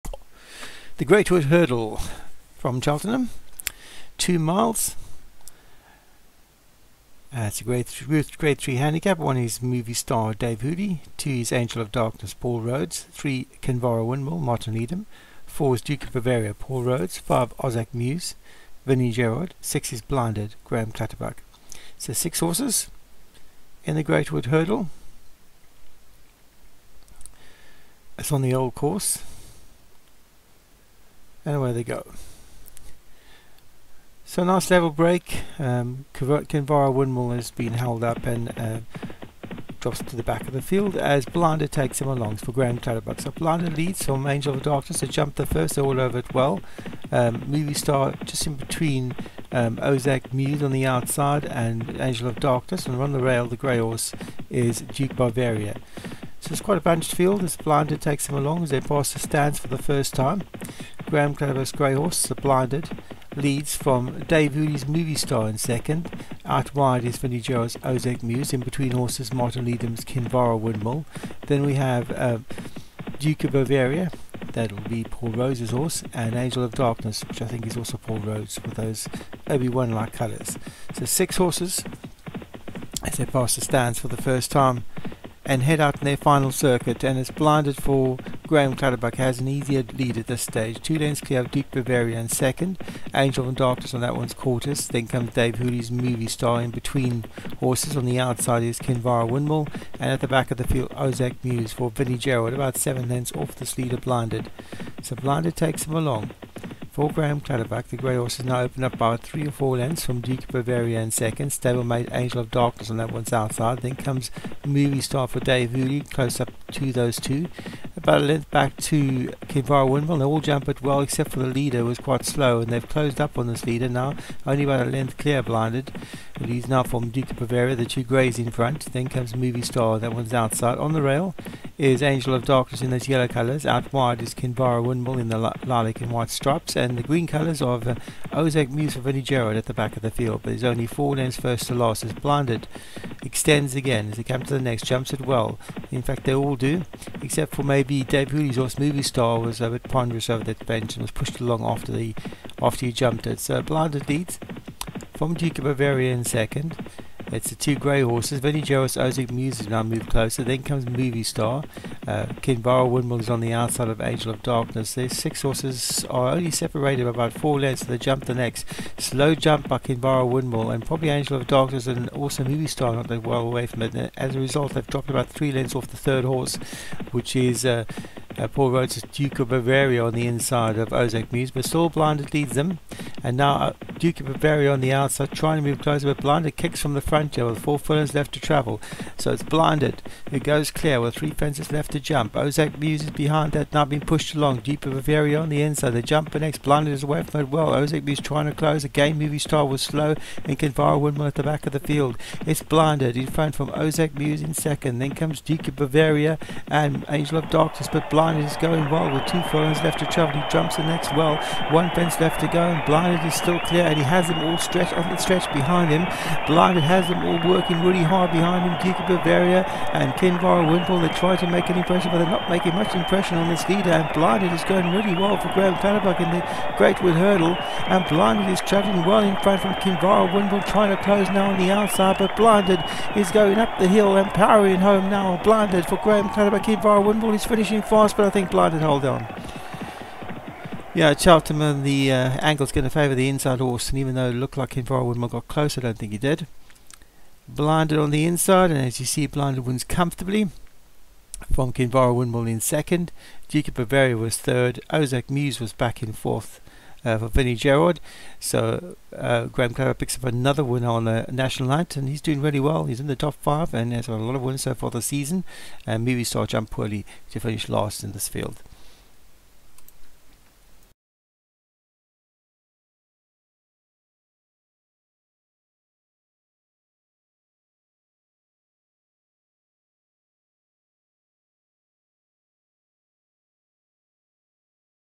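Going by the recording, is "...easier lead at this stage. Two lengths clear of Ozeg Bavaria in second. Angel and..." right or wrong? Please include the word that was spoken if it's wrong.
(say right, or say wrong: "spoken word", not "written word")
wrong: "Duke", not "Ozeg".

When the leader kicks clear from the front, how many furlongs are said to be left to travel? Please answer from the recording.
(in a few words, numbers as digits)
4.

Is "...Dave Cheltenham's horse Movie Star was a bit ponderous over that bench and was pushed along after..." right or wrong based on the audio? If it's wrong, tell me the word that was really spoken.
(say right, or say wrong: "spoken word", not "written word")
wrong: "Hooley", not "Cheltenham".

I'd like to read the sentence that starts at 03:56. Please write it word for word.
Kinvara Wimpole is finishing fast, but I think Blinded hold on.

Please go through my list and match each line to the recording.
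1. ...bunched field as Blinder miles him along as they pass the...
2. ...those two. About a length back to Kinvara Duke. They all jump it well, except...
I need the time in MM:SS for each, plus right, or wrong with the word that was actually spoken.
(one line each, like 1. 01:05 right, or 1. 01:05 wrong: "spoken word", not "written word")
1. 00:56 wrong: "takes", not "miles"
2. 01:56 wrong: "Windmill", not "Duke".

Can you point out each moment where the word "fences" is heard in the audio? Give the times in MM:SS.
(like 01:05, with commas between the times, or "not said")
03:11, 03:31.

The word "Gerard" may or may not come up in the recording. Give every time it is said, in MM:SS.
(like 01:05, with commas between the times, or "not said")
00:19, 01:42, 02:19, 04:17.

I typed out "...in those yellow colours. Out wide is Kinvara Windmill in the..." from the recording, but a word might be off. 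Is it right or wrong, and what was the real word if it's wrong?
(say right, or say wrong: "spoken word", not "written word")
right.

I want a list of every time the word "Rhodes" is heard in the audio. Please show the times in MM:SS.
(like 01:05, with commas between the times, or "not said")
00:12, 00:16, 01:15, 02:58.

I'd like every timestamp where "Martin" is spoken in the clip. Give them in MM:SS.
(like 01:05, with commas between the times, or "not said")
00:14, 01:09.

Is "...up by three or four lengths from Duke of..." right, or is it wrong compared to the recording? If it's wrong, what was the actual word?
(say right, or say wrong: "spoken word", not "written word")
right.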